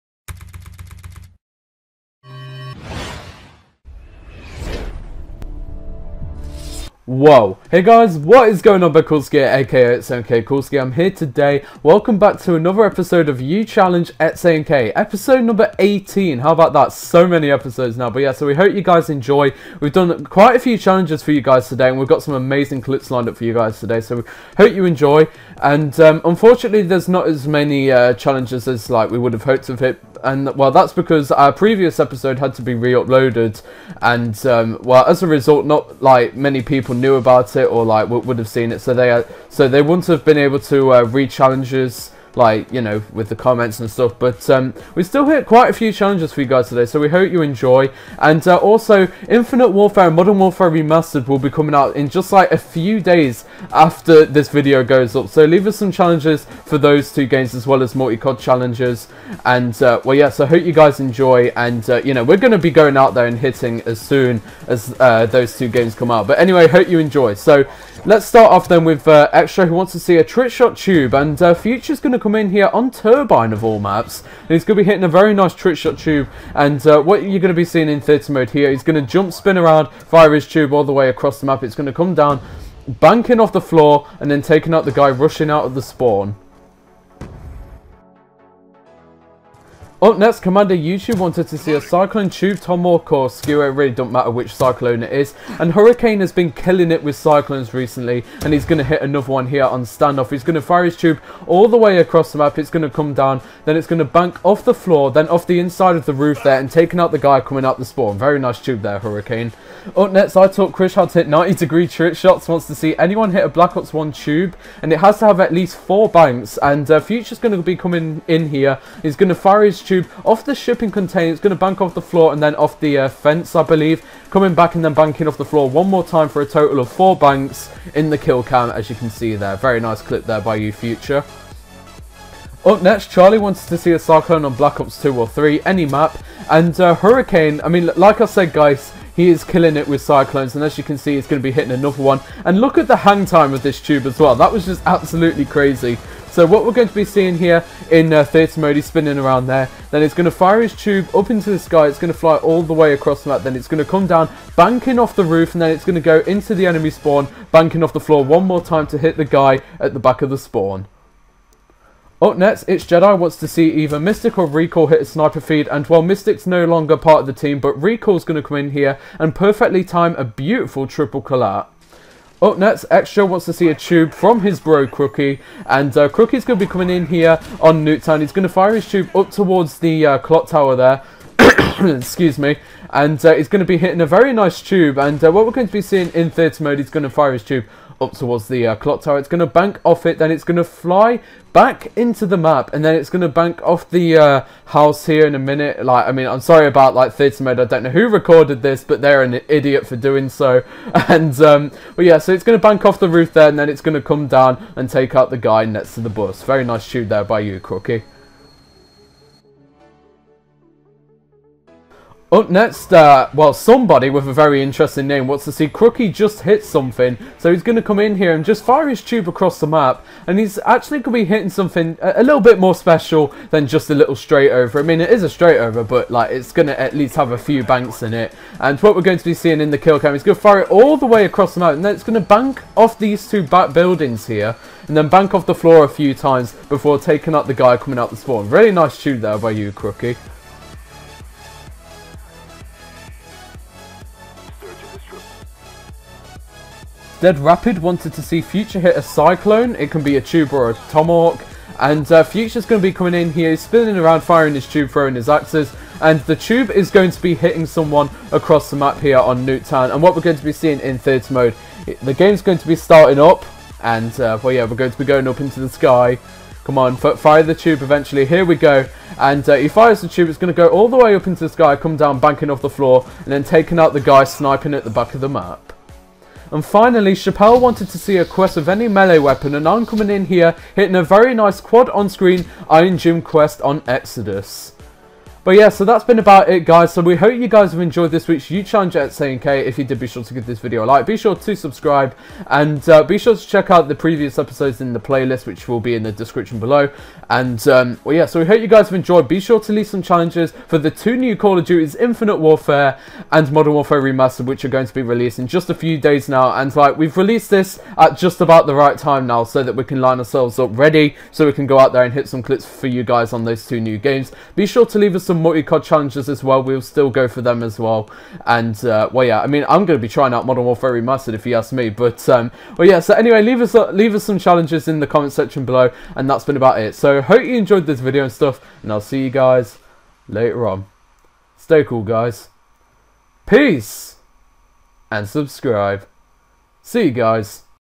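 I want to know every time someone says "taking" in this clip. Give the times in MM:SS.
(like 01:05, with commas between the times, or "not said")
01:24, 01:46, 03:56, 04:33.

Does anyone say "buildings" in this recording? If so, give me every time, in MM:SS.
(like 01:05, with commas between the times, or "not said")
03:53.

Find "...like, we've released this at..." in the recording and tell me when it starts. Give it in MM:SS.
05:06.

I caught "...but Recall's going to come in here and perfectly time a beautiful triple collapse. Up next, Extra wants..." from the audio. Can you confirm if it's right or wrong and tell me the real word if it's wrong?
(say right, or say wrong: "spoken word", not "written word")
right.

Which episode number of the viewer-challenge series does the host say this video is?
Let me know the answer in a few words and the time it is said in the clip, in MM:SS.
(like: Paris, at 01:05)
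18, at 00:14.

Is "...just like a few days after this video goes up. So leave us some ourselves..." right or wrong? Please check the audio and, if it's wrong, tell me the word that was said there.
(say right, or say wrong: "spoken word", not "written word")
wrong: "challenges", not "ourselves".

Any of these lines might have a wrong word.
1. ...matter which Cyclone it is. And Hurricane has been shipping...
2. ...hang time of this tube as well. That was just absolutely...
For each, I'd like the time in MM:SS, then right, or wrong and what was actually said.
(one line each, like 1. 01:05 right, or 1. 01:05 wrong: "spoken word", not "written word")
1. 01:34 wrong: "killing", not "shipping"
2. 02:22 right.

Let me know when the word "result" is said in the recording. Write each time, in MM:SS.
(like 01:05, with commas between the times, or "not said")
00:35.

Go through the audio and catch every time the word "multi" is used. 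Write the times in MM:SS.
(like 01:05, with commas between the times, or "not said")
00:57, 05:15.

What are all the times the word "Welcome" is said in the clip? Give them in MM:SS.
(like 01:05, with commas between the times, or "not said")
00:11.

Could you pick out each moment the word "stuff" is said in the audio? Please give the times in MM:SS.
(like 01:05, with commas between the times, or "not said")
00:43, 05:28.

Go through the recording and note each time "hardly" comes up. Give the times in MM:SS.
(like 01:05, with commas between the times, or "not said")
not said.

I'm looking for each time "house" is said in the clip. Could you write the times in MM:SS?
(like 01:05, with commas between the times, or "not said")
03:14.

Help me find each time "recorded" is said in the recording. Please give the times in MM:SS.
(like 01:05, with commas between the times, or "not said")
03:18.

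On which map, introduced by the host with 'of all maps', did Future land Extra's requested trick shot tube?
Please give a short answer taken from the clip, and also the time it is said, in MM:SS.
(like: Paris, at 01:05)
Turbine, at 01:12.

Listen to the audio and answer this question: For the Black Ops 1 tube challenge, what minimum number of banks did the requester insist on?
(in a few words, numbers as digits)
4.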